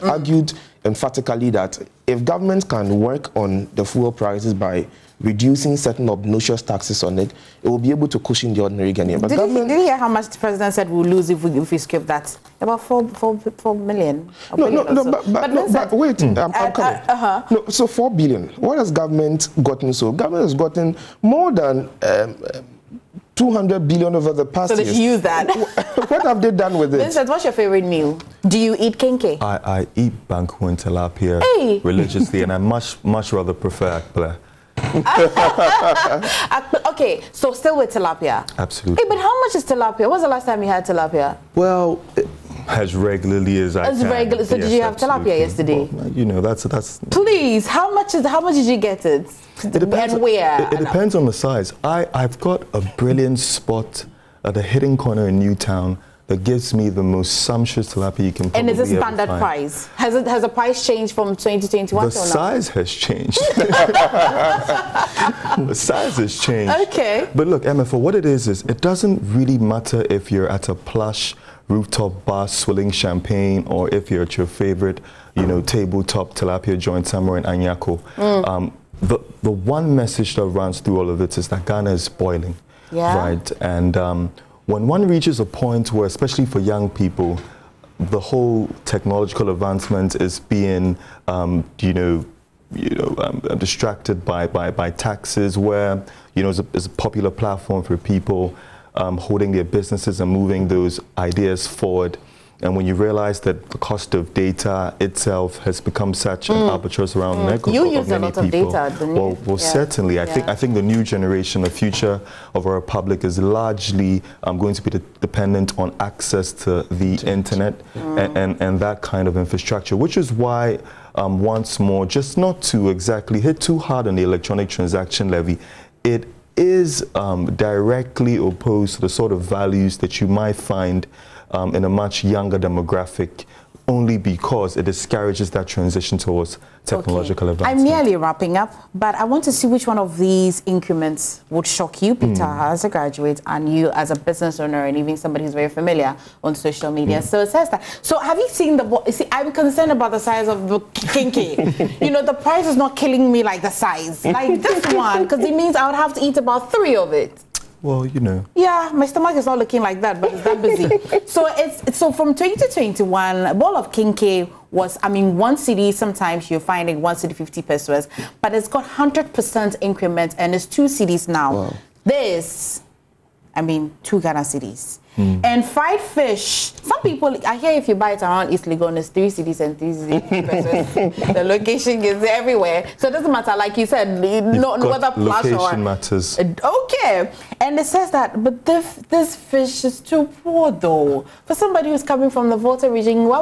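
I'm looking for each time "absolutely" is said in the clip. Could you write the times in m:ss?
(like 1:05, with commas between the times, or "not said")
0:38, 0:44.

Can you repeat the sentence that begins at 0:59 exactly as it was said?
Has it has the price changed from 2021 The size has changed.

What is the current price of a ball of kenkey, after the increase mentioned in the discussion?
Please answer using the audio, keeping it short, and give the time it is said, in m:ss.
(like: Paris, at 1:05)
2 cedis, at 2:50.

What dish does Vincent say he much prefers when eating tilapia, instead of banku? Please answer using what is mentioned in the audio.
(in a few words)
akple.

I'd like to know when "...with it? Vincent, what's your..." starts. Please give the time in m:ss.
0:26.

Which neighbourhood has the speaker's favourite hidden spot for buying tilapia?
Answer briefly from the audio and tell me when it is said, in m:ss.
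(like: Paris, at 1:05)
Newtown, at 0:55.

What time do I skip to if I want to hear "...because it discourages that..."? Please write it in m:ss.
2:14.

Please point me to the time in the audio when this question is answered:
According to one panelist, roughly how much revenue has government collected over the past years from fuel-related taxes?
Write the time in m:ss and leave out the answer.
0:23.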